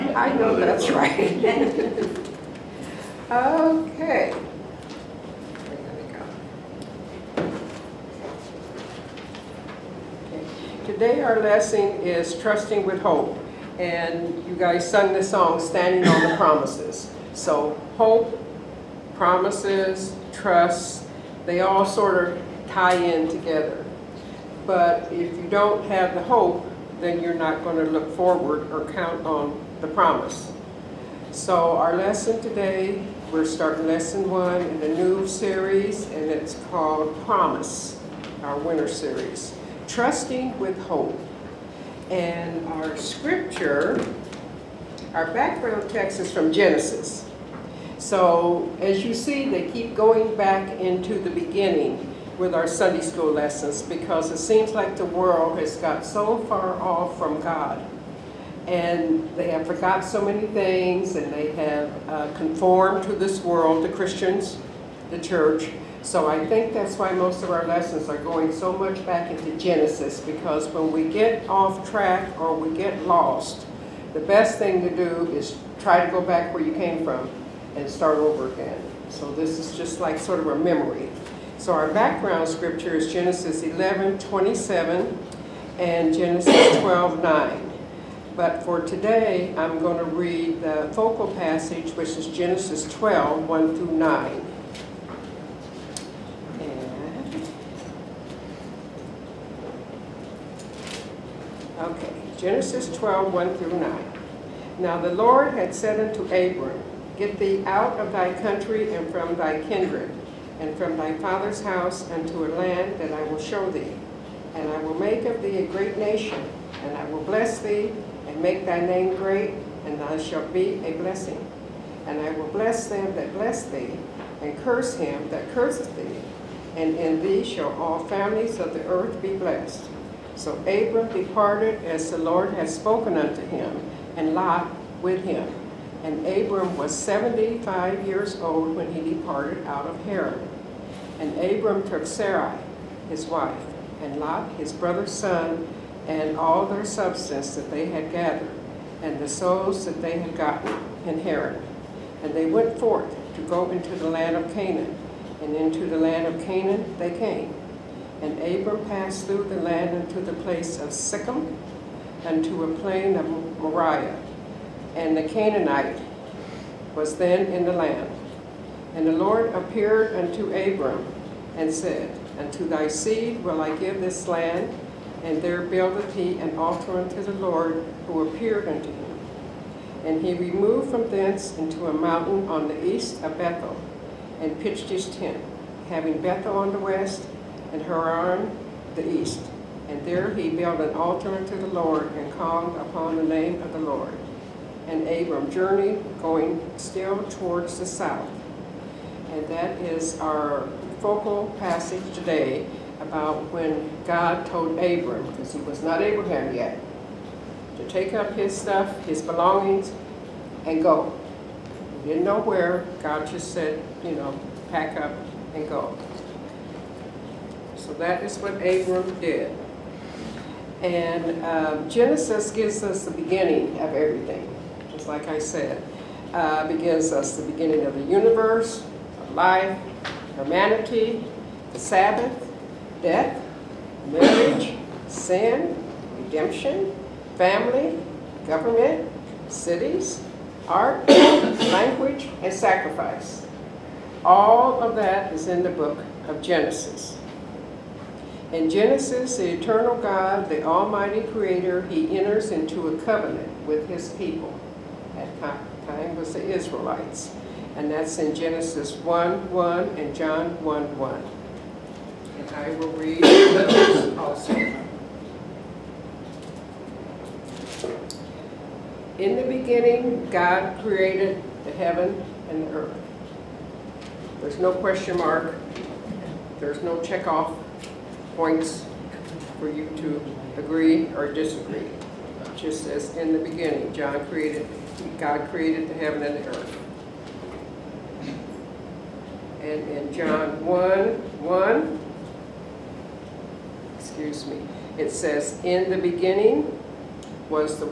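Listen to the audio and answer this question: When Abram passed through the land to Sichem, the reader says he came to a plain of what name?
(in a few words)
Moriah.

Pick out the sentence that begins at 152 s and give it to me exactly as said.
And they went forth to go into the land of Canaan.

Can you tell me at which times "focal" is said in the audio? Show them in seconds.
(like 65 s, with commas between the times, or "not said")
90 s, 201 s.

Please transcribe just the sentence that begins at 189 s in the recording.
And there he built an altar unto the Lord and called upon the name of the Lord.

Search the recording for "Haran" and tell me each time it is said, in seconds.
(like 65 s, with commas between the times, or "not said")
140 s, 151 s, 187 s.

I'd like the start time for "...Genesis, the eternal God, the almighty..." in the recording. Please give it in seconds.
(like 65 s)
248 s.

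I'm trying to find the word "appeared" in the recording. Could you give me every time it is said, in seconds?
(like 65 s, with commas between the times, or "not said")
169 s, 178 s.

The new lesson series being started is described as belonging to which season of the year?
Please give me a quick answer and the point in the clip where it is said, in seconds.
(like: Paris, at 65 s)
Winter, at 38 s.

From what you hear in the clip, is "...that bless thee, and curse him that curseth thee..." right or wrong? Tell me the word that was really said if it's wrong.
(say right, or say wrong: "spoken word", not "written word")
right.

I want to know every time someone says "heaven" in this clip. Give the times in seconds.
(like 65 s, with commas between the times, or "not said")
271 s, 285 s.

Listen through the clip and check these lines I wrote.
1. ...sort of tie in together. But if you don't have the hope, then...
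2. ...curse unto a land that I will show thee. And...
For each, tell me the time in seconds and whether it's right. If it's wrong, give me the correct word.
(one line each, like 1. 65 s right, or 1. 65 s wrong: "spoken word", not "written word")
1. 21 s right
2. 111 s wrong: "house", not "curse".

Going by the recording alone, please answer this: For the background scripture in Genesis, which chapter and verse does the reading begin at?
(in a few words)
Genesis 11:27.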